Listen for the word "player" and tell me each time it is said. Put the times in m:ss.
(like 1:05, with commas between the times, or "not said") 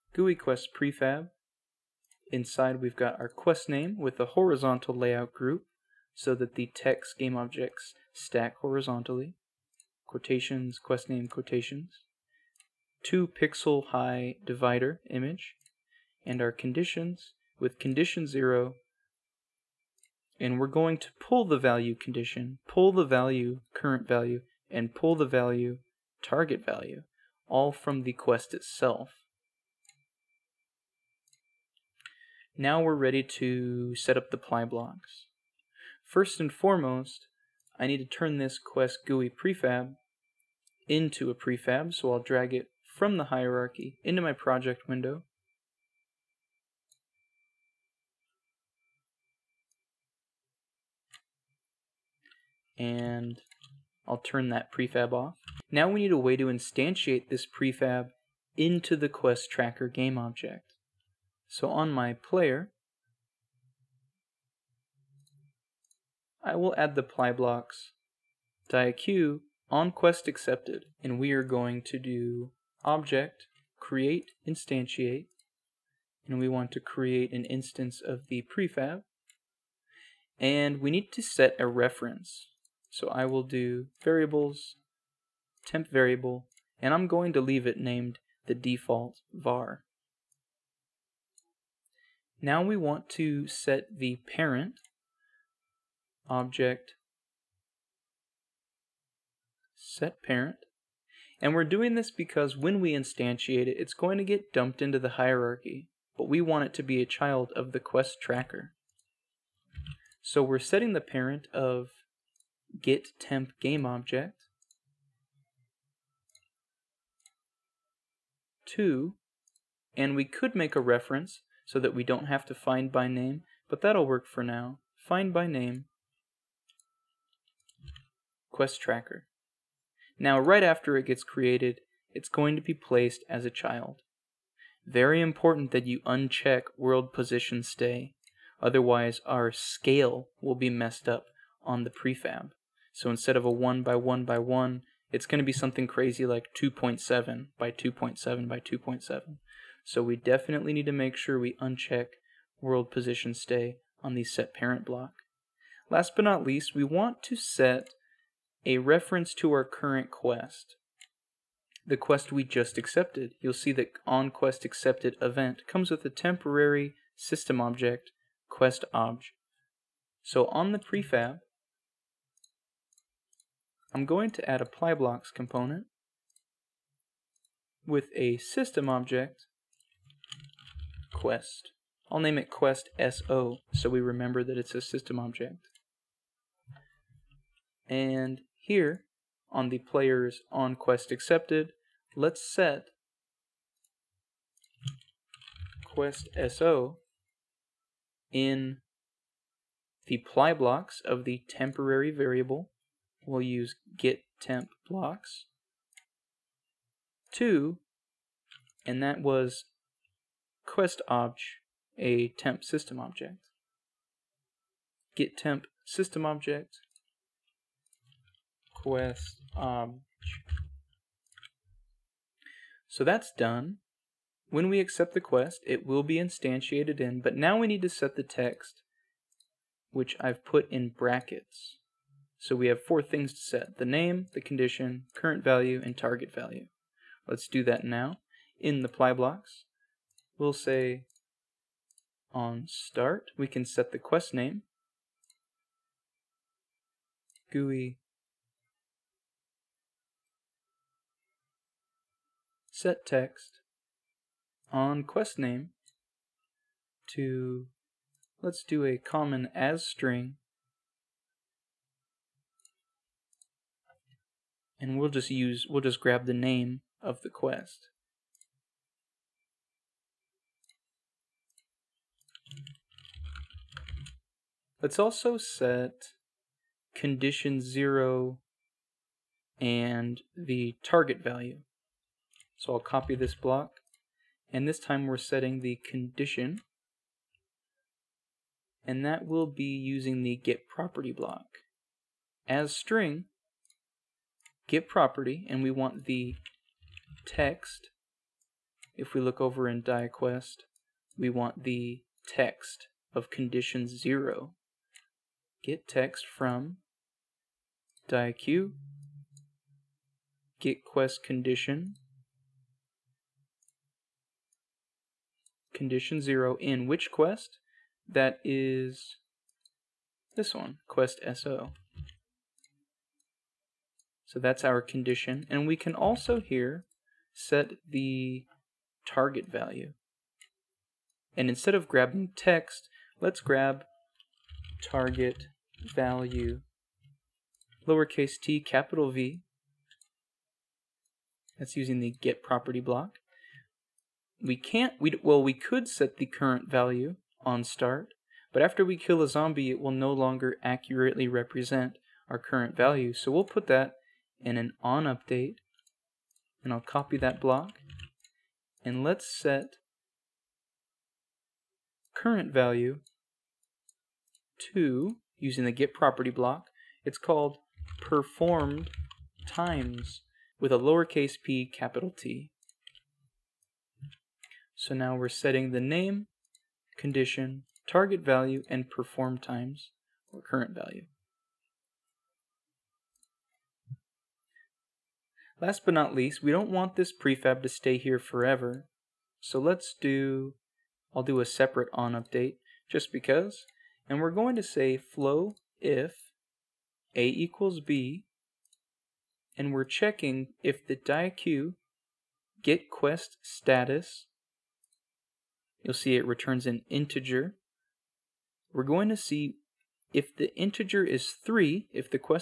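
1:02, 3:09.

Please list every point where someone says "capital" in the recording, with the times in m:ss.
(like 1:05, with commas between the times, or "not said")
5:38, 6:11.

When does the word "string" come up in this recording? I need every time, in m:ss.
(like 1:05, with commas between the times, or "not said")
4:19, 4:52.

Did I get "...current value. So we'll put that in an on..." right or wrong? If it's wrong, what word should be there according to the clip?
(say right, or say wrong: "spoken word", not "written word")
right.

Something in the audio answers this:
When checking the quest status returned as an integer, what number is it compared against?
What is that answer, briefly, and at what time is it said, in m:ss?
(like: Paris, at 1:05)
3, at 6:51.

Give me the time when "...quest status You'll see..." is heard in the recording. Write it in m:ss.
6:42.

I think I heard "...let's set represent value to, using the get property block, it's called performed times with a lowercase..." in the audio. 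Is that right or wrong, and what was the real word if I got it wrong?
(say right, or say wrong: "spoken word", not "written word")
wrong: "current", not "represent".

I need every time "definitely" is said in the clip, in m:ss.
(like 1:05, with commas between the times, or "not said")
2:30.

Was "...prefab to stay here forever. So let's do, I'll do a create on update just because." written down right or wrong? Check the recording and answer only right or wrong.
wrong.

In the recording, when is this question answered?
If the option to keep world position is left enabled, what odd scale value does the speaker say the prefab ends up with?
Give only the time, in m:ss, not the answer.
2:26.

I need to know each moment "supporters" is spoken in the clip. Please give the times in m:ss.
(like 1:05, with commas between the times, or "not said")
not said.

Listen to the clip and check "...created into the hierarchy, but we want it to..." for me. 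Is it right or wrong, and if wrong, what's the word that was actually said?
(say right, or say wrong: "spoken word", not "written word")
wrong: "dumped", not "created".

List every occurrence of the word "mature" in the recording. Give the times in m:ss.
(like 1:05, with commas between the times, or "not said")
not said.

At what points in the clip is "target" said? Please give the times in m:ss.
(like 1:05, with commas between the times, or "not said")
0:26, 3:55, 4:40, 5:29, 5:34, 6:17.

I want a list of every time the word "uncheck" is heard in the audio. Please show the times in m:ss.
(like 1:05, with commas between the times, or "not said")
2:16, 2:31.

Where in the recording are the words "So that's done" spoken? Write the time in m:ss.
3:42.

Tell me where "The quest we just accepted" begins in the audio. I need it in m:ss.
2:41.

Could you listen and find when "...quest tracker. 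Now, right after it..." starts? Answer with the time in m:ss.
2:08.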